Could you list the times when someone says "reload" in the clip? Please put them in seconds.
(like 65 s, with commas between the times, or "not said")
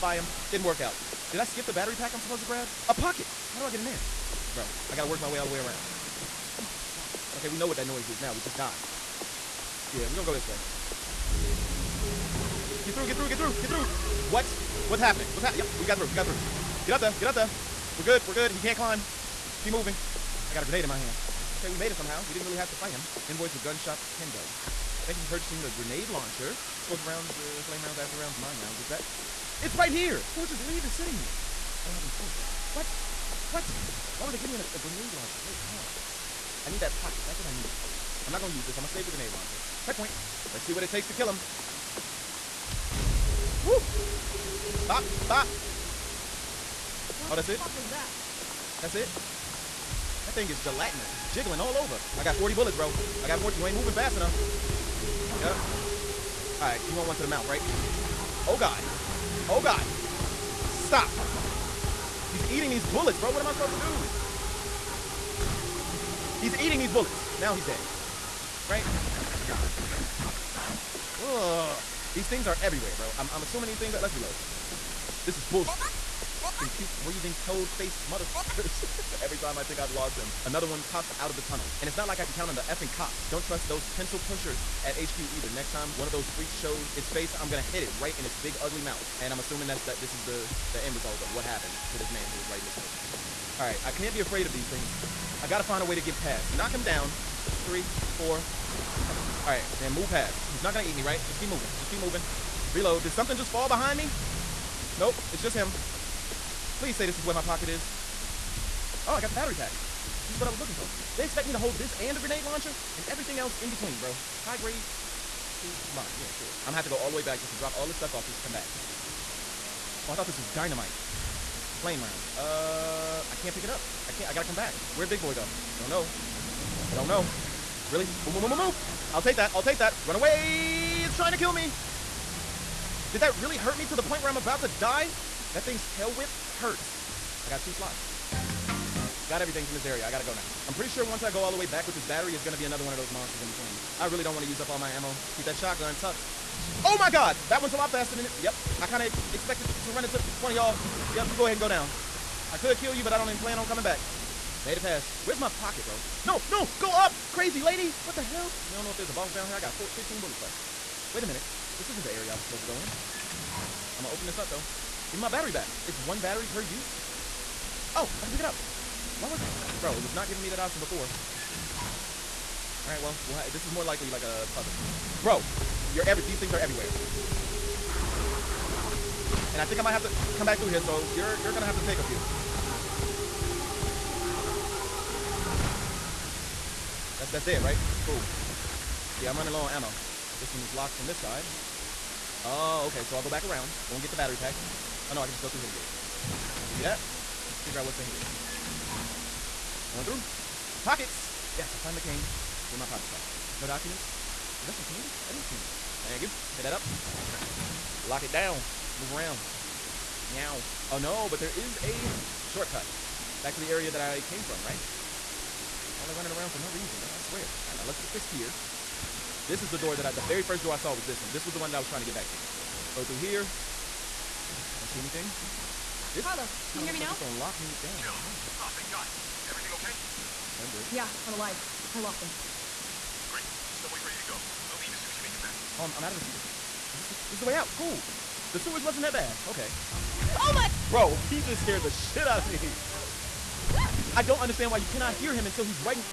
74 s, 102 s.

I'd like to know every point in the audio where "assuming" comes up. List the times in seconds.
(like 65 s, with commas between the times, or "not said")
73 s, 89 s.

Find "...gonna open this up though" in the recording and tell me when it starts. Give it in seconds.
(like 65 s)
164 s.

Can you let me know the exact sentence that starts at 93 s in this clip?
All right, I can't be afraid of these things.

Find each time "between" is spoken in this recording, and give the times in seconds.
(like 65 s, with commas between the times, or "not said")
113 s, 143 s.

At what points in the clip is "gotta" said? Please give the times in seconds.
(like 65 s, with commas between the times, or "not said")
4 s, 95 s, 124 s, 140 s.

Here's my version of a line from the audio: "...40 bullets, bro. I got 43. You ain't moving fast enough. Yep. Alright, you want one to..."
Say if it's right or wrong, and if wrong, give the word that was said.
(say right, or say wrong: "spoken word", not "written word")
wrong: "40", not "43".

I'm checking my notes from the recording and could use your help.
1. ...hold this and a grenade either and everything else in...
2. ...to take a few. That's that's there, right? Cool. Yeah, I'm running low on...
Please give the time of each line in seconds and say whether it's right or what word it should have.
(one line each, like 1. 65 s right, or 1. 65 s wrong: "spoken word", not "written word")
1. 111 s wrong: "launcher", not "either"
2. 181 s right.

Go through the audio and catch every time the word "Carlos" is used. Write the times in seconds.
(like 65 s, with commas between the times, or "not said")
226 s.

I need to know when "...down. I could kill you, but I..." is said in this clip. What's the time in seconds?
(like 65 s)
151 s.